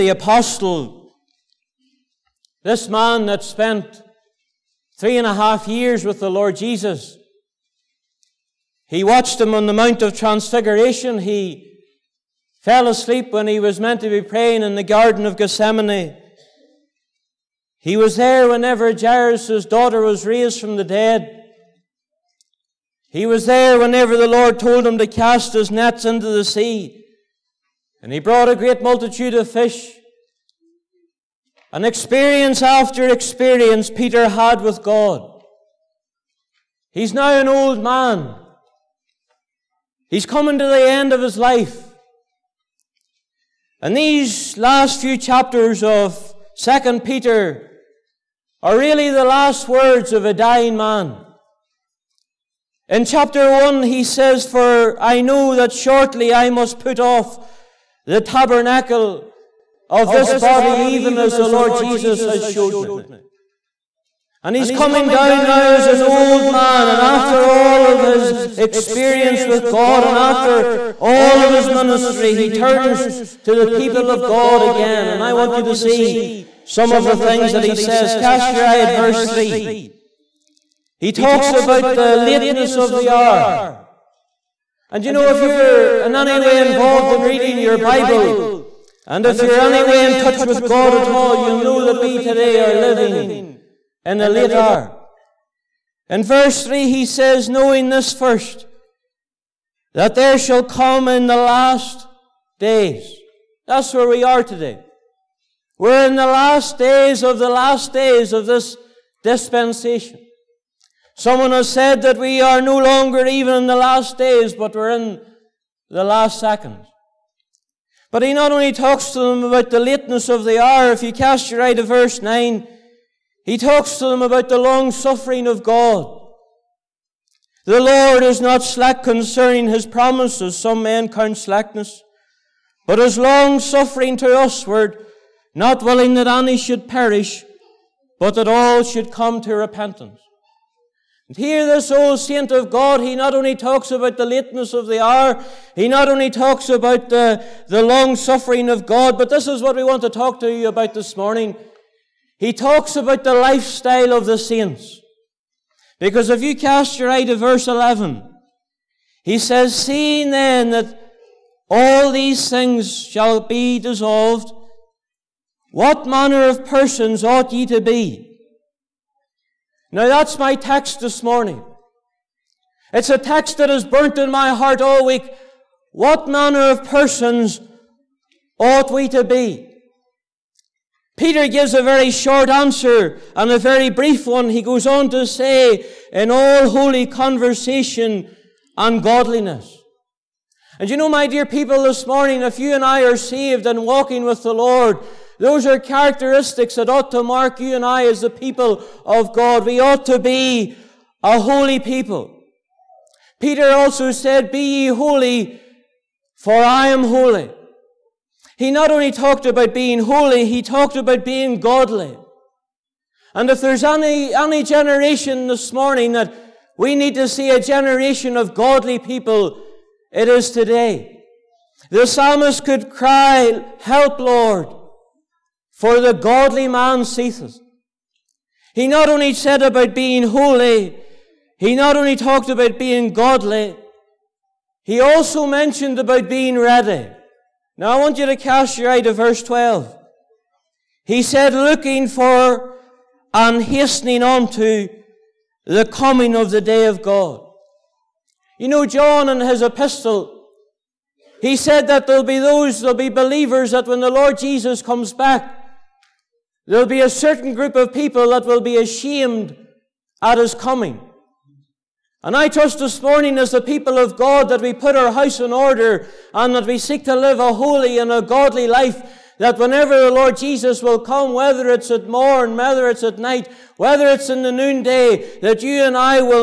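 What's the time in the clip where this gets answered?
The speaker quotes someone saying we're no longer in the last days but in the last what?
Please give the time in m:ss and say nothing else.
1:56.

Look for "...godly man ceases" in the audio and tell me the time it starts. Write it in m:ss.
3:46.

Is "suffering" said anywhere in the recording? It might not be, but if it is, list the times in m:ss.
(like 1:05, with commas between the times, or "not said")
2:04, 2:13, 2:28.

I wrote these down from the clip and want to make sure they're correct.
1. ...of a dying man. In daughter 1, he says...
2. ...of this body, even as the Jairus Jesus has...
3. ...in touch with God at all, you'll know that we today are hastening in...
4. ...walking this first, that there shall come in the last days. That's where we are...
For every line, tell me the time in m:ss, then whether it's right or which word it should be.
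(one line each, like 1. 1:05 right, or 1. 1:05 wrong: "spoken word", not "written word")
1. 0:50 wrong: "chapter", not "daughter"
2. 0:59 wrong: "Lord", not "Jairus"
3. 1:30 wrong: "living", not "hastening"
4. 1:37 wrong: "knowing", not "walking".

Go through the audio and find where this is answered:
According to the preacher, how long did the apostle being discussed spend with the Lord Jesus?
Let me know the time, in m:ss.
0:04.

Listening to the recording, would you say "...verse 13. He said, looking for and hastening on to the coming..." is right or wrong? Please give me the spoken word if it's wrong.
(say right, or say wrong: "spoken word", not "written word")
wrong: "12", not "13".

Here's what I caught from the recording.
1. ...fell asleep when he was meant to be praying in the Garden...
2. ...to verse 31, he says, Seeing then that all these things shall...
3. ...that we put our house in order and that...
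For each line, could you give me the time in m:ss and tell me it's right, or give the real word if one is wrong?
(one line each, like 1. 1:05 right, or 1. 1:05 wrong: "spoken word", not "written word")
1. 0:12 right
2. 2:37 wrong: "11", not "31"
3. 4:24 right.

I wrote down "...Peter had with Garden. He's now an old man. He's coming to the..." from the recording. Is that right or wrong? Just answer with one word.
wrong.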